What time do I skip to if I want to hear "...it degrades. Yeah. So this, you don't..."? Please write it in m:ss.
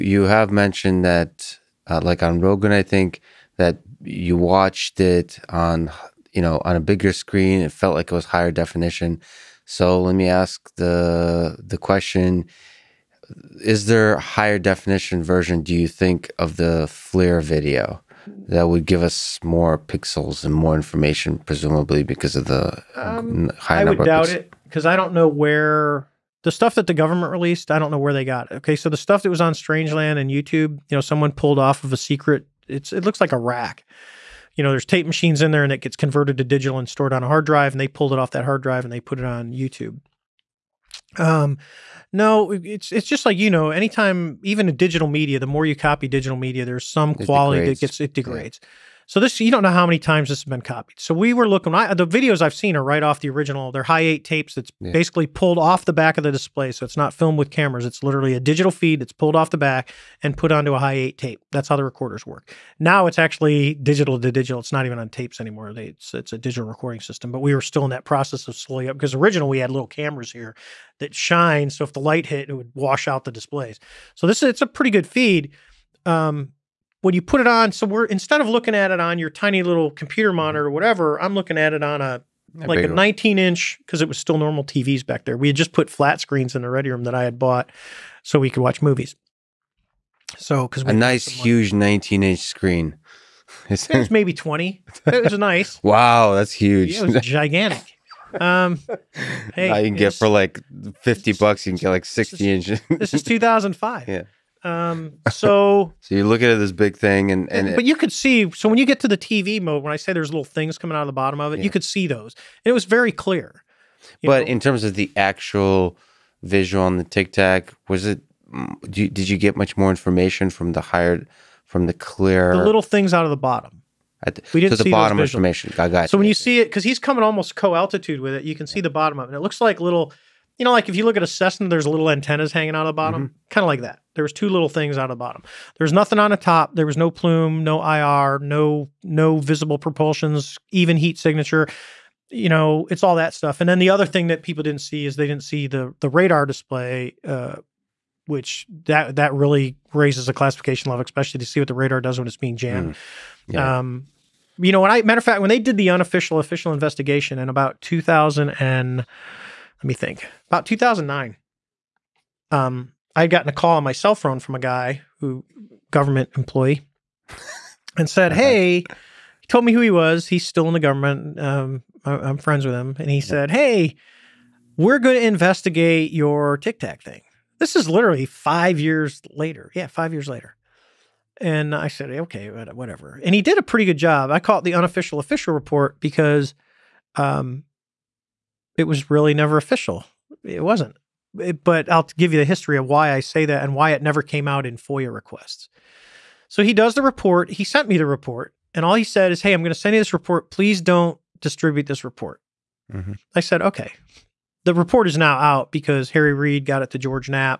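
0:48.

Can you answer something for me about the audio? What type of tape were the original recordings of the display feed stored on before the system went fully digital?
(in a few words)
Hi8.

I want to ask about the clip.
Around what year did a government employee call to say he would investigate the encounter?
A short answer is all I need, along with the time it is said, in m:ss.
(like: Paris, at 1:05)
2009, at 2:40.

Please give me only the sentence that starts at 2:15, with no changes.
There was nothing on the top.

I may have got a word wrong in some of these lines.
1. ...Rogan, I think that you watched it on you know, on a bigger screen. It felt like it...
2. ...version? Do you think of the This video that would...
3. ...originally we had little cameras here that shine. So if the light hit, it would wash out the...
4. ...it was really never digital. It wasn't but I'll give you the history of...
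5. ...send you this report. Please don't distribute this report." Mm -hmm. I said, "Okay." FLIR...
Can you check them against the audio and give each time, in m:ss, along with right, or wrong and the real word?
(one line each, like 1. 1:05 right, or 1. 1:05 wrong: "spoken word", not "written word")
1. 0:02 right
2. 0:15 wrong: "FLIR", not "This"
3. 1:09 right
4. 3:08 wrong: "official", not "digital"
5. 3:19 wrong: "The", not "FLIR".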